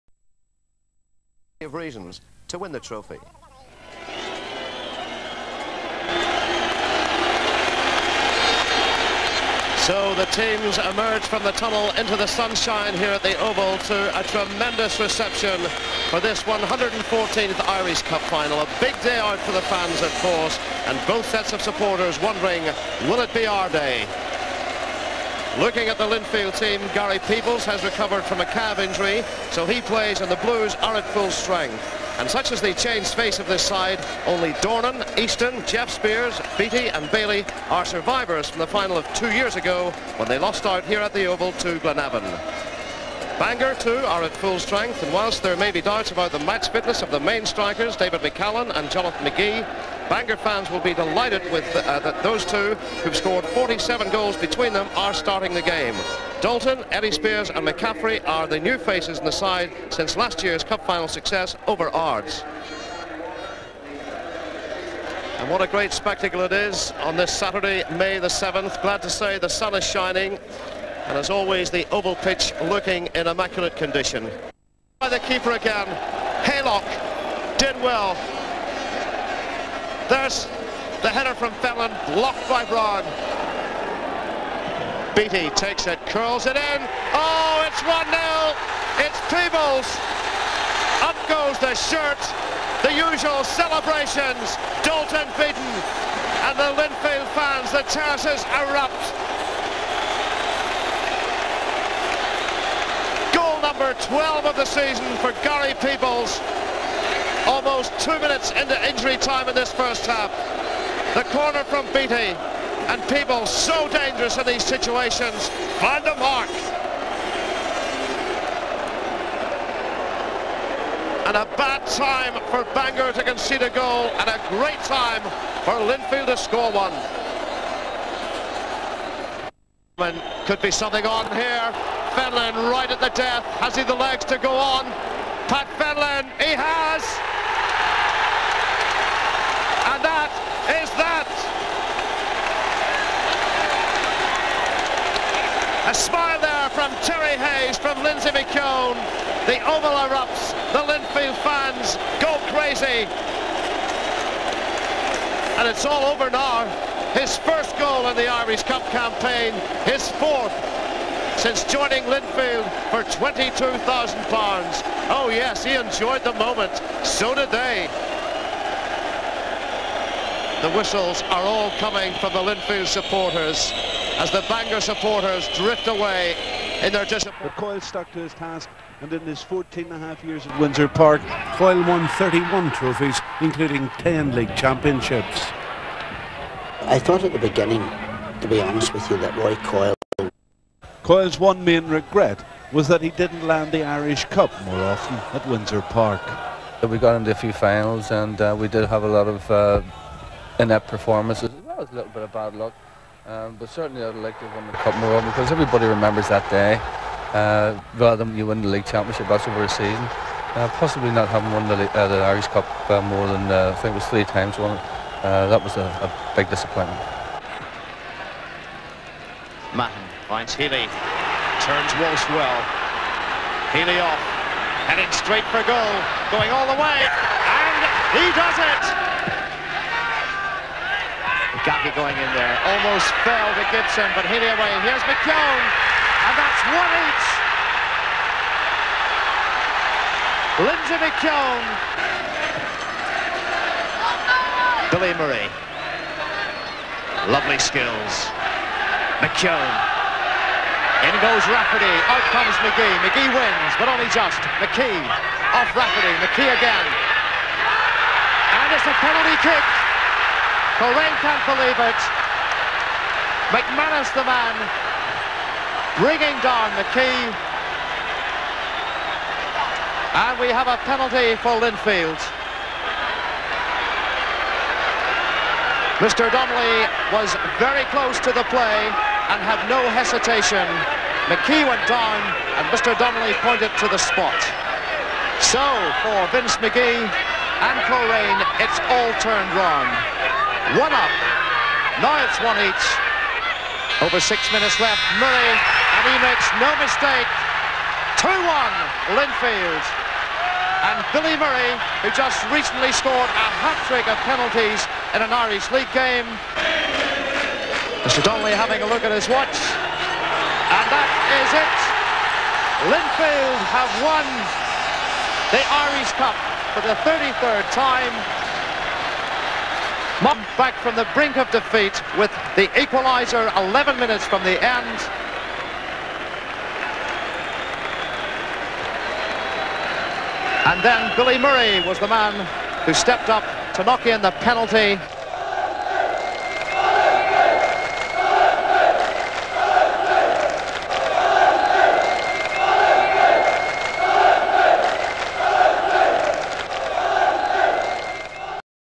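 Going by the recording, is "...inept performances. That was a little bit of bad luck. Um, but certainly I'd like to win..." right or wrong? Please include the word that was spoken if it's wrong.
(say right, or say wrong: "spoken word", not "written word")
right.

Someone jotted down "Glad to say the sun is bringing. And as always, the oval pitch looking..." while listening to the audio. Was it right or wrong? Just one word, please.
wrong.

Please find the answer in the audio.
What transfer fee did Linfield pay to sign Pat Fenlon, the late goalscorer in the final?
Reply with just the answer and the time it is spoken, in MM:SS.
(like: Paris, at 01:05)
£22,000, at 02:43.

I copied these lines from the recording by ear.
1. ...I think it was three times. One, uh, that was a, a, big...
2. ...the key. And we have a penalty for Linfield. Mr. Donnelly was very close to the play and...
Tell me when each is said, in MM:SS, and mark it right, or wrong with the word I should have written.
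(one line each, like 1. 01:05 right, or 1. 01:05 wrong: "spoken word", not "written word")
1. 03:33 right
2. 04:26 right.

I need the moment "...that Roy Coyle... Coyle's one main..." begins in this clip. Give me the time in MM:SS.
03:09.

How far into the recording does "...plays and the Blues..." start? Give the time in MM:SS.
00:29.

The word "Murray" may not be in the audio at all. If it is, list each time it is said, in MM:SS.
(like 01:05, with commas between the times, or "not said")
04:05, 04:55, 05:01, 05:31.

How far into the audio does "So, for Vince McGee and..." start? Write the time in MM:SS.
04:45.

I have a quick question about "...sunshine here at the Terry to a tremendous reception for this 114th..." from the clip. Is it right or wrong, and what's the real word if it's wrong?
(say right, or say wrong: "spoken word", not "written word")
wrong: "Oval", not "Terry".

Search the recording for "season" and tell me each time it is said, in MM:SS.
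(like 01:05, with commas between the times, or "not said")
01:44, 03:29.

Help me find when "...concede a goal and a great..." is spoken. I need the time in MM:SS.
02:03.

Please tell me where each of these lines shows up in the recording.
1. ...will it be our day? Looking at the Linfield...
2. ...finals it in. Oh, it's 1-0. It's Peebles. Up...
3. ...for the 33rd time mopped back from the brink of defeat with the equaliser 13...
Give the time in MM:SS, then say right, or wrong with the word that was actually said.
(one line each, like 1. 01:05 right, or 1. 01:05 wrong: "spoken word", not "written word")
1. 00:23 right
2. 01:26 wrong: "curls", not "finals"
3. 05:16 wrong: "11", not "13".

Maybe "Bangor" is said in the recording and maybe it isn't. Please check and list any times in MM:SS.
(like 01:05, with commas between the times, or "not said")
00:43, 00:50, 02:02, 02:54.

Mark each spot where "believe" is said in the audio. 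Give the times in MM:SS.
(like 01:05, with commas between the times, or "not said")
04:21.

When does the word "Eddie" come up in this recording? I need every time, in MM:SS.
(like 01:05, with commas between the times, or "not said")
00:56.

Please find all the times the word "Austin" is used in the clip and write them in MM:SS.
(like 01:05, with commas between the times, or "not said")
not said.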